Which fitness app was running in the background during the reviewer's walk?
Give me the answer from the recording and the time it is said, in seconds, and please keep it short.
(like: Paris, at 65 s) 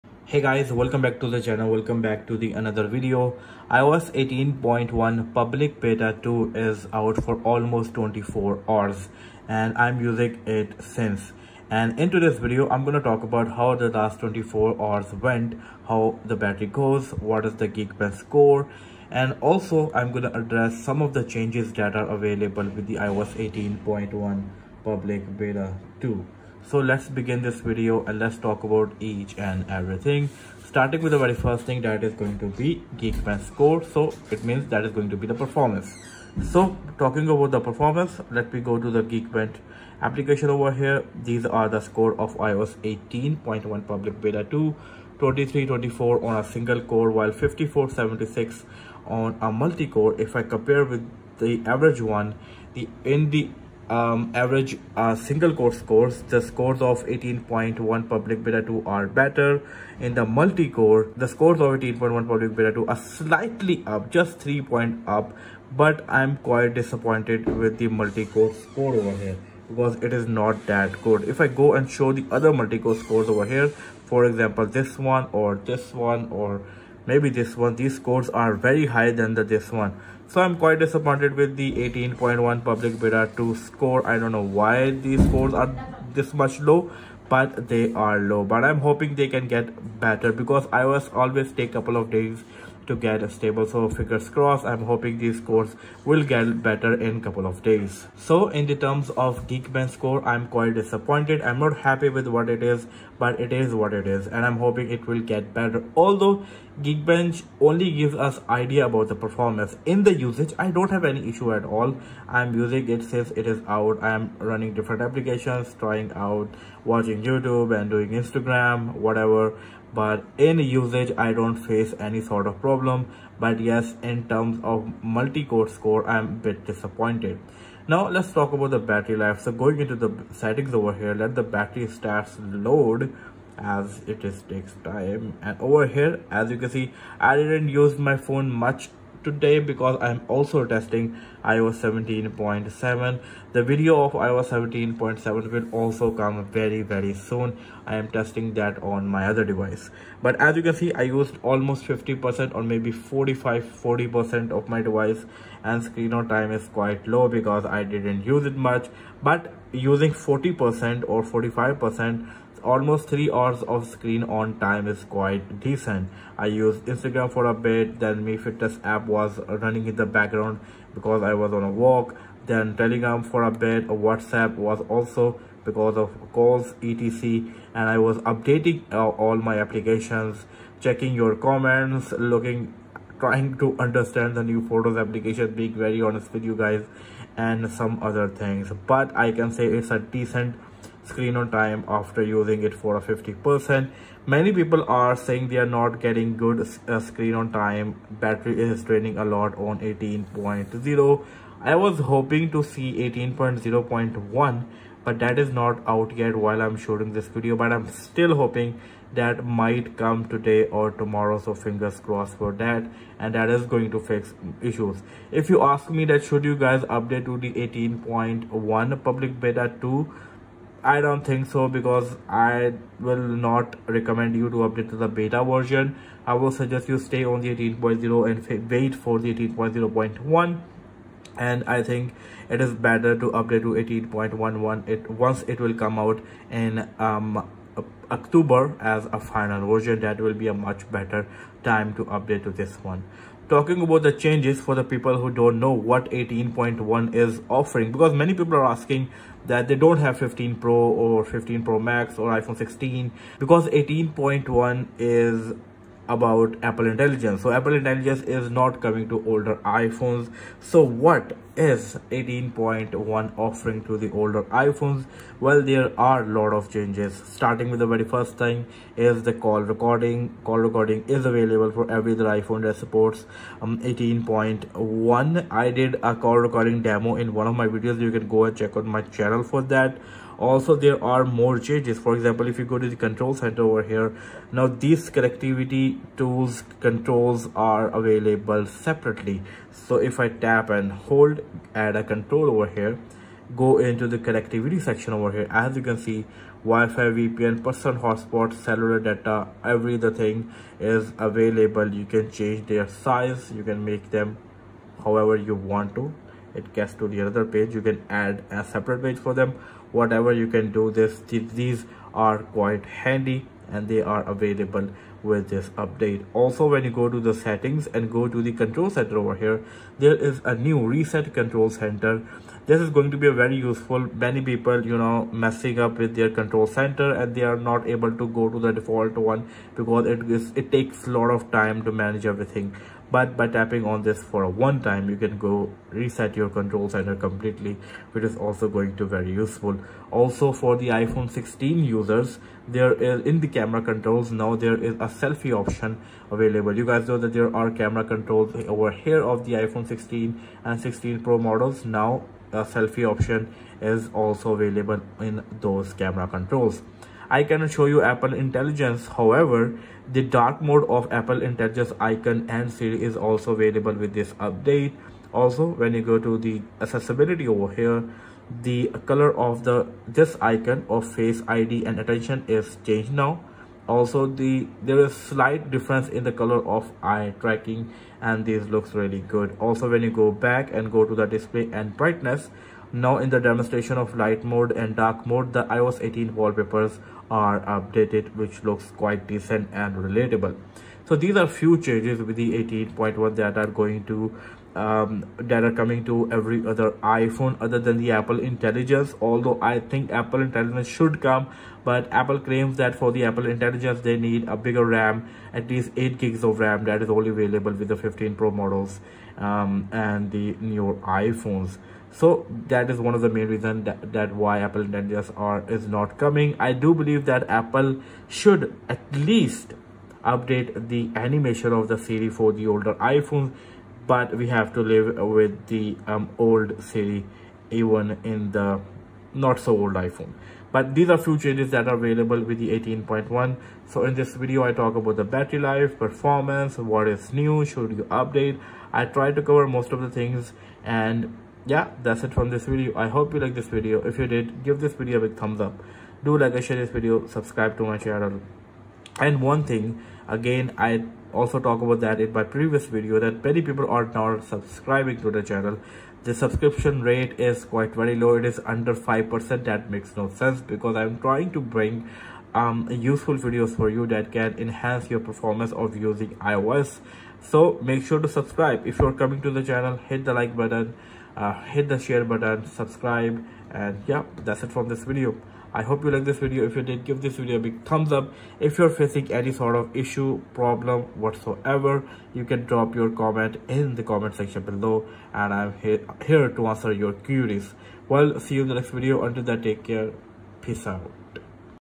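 Mi Fitness, at 168 s.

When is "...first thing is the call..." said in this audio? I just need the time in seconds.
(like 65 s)
268 s.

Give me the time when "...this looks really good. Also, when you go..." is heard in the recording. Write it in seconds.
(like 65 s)
378 s.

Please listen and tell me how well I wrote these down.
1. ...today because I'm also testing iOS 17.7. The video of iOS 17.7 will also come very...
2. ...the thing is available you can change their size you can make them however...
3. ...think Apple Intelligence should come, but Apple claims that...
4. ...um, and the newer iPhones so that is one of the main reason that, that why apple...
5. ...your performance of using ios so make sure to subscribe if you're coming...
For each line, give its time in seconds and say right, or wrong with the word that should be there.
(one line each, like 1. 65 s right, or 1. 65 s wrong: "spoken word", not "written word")
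1. 139 s right
2. 299 s right
3. 399 s right
4. 409 s right
5. 465 s right.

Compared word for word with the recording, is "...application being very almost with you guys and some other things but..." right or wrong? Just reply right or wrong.
wrong.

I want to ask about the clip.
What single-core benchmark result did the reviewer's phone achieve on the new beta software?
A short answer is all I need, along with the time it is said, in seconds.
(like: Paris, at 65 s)
2324, at 45 s.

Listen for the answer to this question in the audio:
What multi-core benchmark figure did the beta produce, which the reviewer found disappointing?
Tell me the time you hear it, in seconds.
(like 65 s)
47 s.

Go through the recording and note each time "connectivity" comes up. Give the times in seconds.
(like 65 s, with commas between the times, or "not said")
285 s, 294 s.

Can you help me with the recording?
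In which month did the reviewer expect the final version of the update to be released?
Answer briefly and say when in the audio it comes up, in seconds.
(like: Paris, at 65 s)
October, at 238 s.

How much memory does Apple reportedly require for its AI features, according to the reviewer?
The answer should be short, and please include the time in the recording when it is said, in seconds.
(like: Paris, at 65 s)
8 gigs, at 405 s.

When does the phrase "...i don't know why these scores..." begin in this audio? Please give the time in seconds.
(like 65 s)
84 s.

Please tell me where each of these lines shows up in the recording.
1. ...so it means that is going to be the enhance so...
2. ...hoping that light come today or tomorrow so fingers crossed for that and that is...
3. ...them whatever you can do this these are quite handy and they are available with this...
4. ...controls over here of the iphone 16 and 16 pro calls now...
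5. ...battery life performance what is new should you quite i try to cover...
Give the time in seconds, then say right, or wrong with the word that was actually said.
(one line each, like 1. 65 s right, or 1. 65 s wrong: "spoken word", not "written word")
1. 33 s wrong: "performance", not "enhance"
2. 208 s wrong: "might", not "light"
3. 309 s right
4. 348 s wrong: "models", not "calls"
5. 435 s wrong: "update", not "quite".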